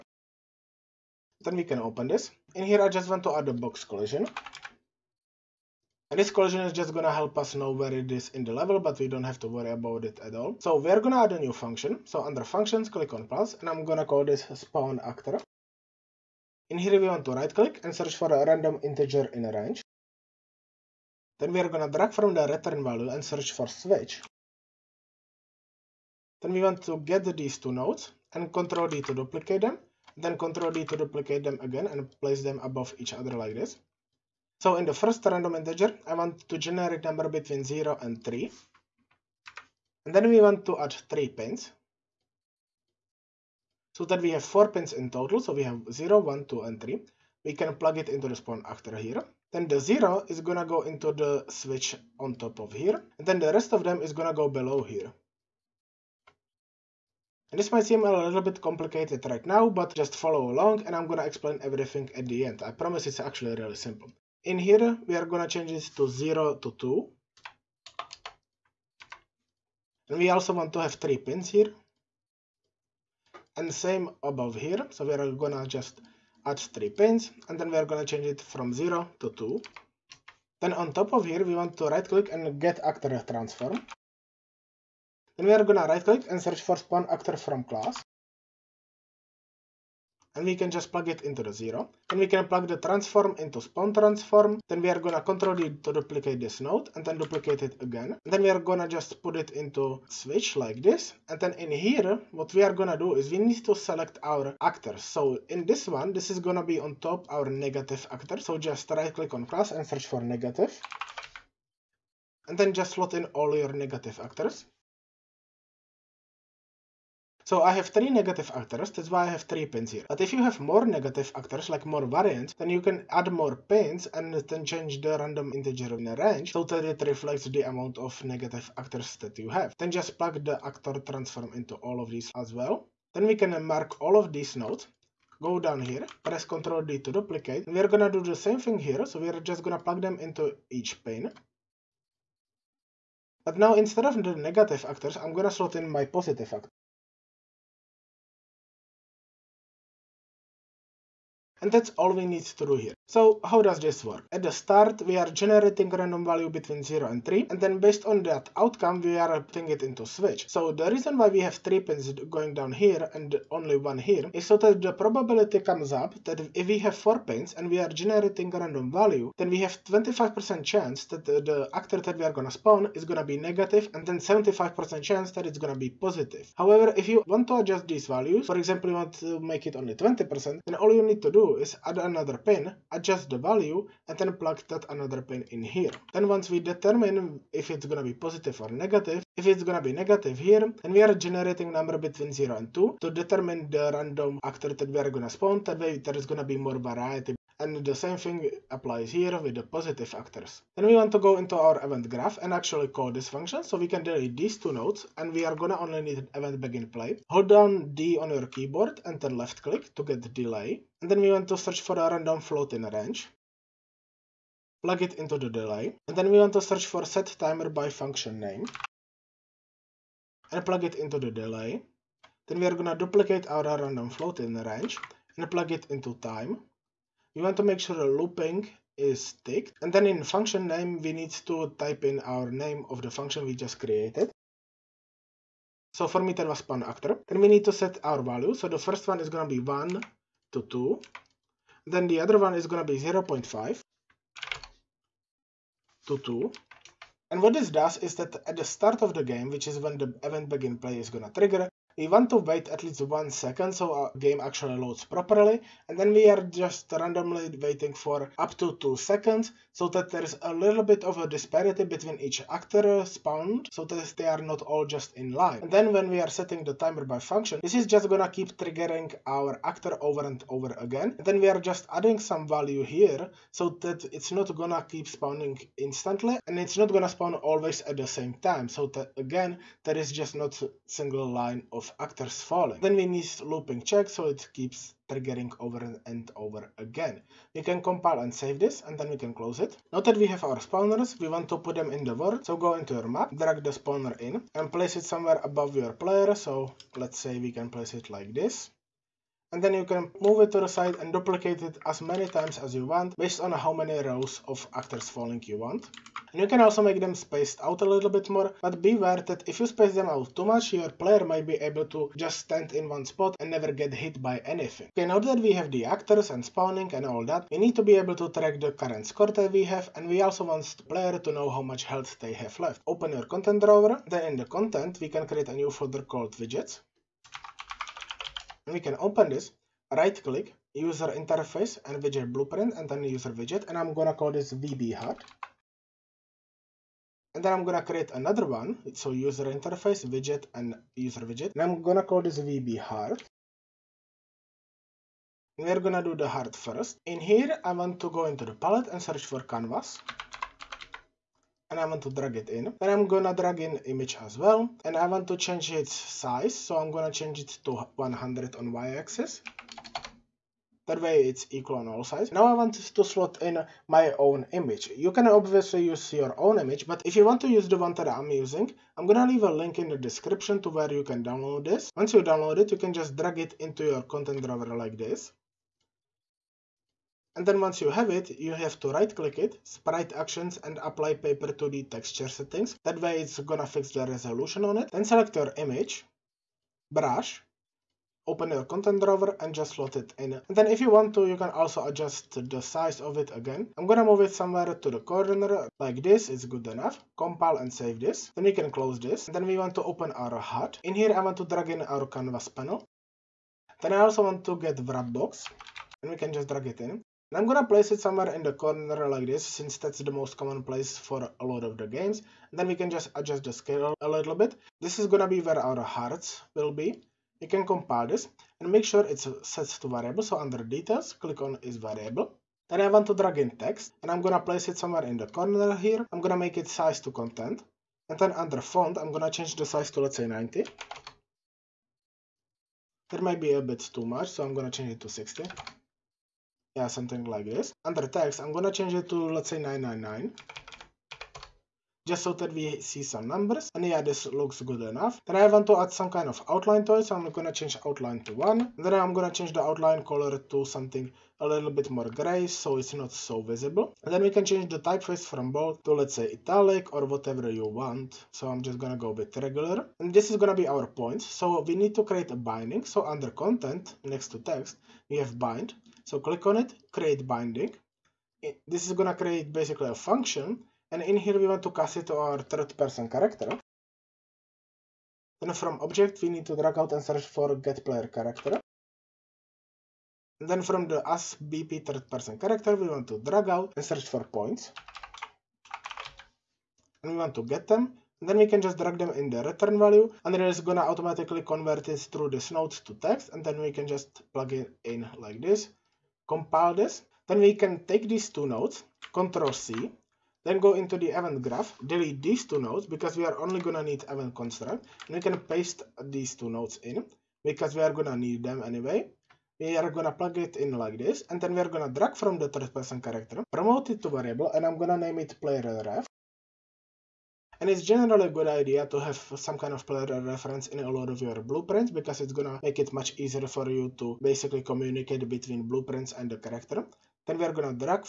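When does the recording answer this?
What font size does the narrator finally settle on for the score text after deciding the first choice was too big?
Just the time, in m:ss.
7:15.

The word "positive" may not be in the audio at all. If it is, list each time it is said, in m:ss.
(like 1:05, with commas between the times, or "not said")
2:26, 2:55, 3:08, 3:19.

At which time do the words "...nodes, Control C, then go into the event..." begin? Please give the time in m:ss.
8:18.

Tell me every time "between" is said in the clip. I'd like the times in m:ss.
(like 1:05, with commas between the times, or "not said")
0:37, 2:36, 3:11, 4:21, 8:45.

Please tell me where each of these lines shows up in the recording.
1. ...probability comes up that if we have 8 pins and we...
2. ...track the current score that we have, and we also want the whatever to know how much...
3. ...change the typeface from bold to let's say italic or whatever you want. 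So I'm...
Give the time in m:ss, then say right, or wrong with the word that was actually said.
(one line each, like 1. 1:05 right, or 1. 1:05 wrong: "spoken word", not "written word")
1. 2:44 wrong: "4", not "8"
2. 5:18 wrong: "player", not "whatever"
3. 7:34 right.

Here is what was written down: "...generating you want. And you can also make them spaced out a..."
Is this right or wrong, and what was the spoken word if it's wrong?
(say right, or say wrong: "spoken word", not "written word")
wrong: "falling", not "generating".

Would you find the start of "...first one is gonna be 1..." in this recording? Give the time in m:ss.
3:58.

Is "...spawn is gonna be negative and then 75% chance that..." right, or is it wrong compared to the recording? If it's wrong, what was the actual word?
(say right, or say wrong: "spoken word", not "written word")
right.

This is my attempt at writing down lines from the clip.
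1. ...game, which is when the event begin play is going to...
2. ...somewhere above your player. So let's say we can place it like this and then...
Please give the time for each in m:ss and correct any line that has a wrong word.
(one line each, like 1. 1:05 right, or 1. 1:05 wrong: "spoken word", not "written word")
1. 4:09 right
2. 4:55 right.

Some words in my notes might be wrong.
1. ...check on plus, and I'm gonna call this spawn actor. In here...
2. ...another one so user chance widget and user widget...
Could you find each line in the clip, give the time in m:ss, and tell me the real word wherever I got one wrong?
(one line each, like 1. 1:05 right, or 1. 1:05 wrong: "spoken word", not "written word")
1. 0:12 wrong: "click", not "check"
2. 5:38 wrong: "interface", not "chance".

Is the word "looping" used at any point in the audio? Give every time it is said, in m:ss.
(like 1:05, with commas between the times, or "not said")
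3:48, 4:43.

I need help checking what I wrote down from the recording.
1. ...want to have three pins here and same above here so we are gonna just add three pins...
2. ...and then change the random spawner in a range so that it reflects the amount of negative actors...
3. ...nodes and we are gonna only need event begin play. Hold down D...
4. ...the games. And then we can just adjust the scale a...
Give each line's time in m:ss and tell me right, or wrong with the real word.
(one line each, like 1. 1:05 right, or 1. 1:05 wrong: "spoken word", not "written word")
1. 1:10 right
2. 2:04 wrong: "integer", not "spawner"
3. 3:24 right
4. 6:51 right.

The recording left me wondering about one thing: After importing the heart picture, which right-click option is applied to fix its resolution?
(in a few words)
Paper2D texture settings.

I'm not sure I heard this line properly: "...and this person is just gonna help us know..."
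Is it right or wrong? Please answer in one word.
wrong.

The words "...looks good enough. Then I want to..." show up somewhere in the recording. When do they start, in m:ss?
7:24.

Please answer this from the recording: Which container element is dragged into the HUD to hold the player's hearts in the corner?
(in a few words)
wrap box.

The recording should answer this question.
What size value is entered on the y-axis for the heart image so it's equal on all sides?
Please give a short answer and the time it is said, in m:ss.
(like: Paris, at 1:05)
100, at 5:57.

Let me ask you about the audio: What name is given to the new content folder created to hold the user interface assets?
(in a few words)
widgets.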